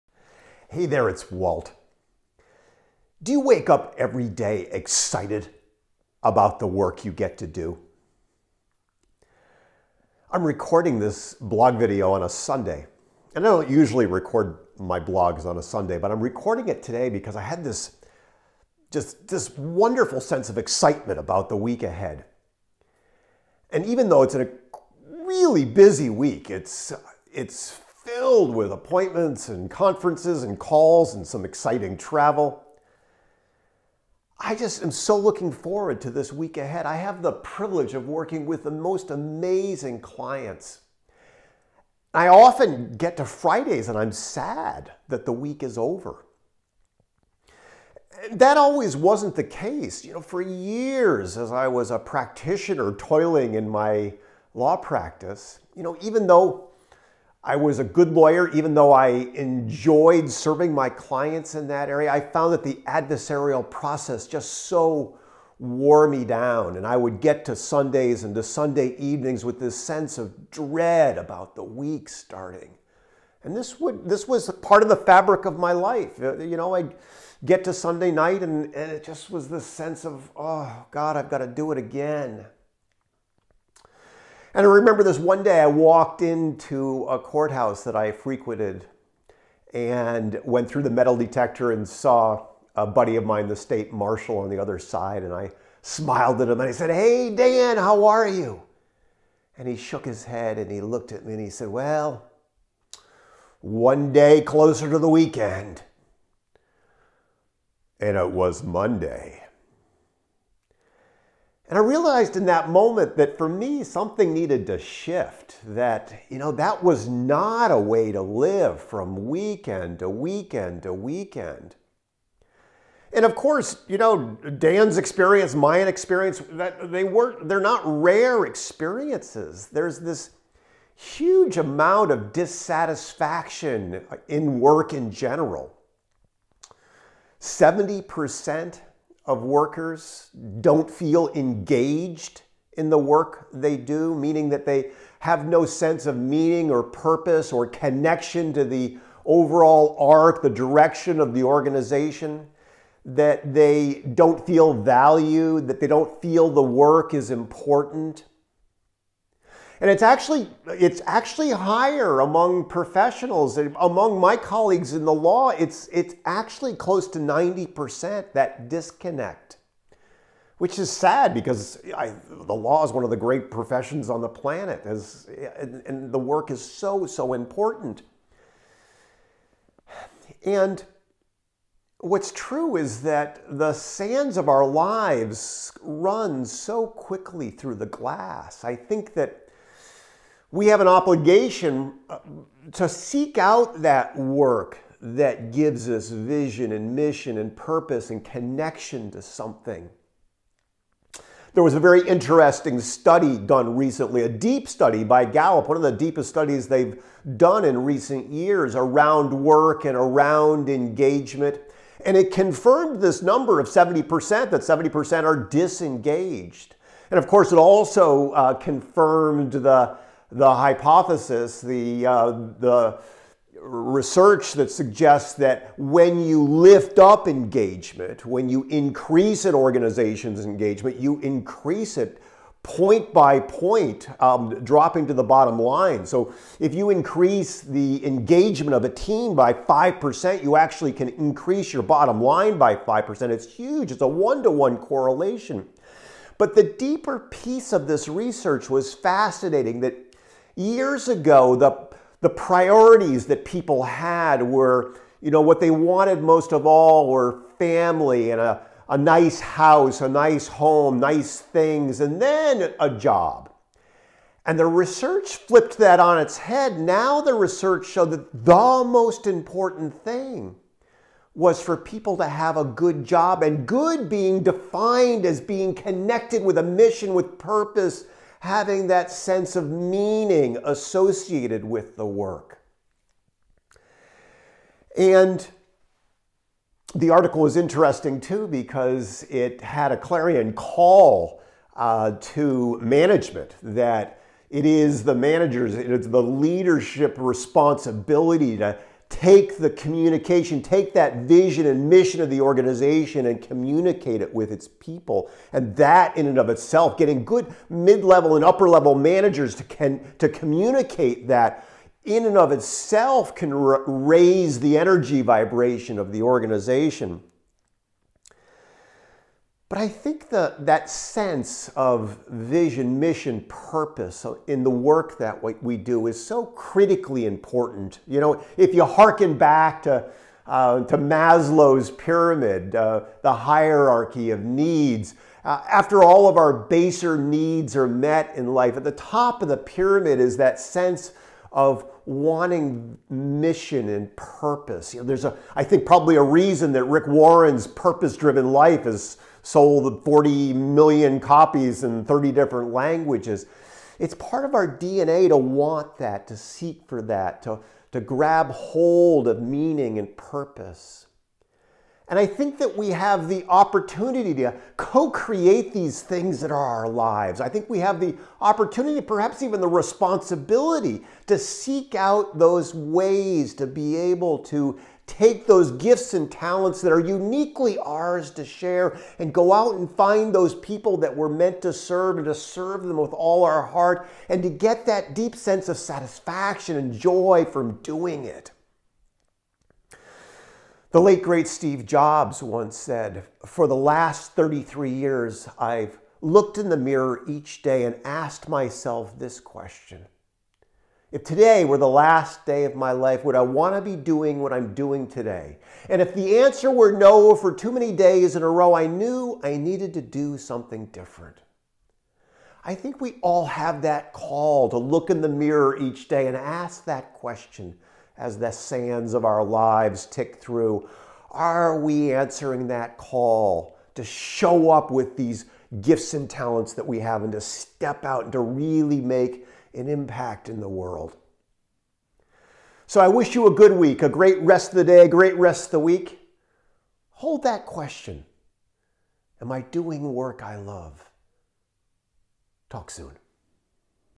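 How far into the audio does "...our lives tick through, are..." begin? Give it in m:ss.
6:59.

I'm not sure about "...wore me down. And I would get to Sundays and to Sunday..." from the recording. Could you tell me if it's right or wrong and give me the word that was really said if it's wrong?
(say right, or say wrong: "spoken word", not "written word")
right.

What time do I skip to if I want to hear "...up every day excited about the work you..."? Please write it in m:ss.
0:03.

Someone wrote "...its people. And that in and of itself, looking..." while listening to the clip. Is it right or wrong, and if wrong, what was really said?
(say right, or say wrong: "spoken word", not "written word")
wrong: "getting", not "looking".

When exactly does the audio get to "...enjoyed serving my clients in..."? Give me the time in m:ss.
0:59.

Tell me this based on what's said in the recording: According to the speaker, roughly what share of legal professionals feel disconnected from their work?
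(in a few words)
90%.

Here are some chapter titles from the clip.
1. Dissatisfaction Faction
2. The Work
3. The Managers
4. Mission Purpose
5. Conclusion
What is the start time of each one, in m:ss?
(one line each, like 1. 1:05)
1. 1:50
2. 3:00
3. 4:45
4. 5:20
5. 7:11.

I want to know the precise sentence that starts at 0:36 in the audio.
I have the privilege of working with the most amazing clients.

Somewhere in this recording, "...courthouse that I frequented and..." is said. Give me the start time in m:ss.
1:27.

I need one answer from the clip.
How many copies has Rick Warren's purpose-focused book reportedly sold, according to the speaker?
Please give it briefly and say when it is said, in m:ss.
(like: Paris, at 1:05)
40 million, at 5:50.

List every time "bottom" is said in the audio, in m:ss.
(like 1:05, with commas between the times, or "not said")
3:55, 4:01.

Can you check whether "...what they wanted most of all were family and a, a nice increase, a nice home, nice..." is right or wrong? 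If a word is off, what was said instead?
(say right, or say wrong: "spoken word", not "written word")
wrong: "house", not "increase".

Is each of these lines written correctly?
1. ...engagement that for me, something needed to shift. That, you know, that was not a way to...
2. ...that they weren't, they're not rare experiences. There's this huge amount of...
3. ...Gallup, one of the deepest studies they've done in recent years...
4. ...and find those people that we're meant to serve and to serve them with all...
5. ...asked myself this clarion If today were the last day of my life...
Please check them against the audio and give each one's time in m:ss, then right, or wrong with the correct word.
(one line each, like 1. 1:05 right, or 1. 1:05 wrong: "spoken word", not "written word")
1. 1:52 wrong: "moment", not "engagement"
2. 2:06 right
3. 3:25 right
4. 6:19 right
5. 6:38 wrong: "question", not "clarion".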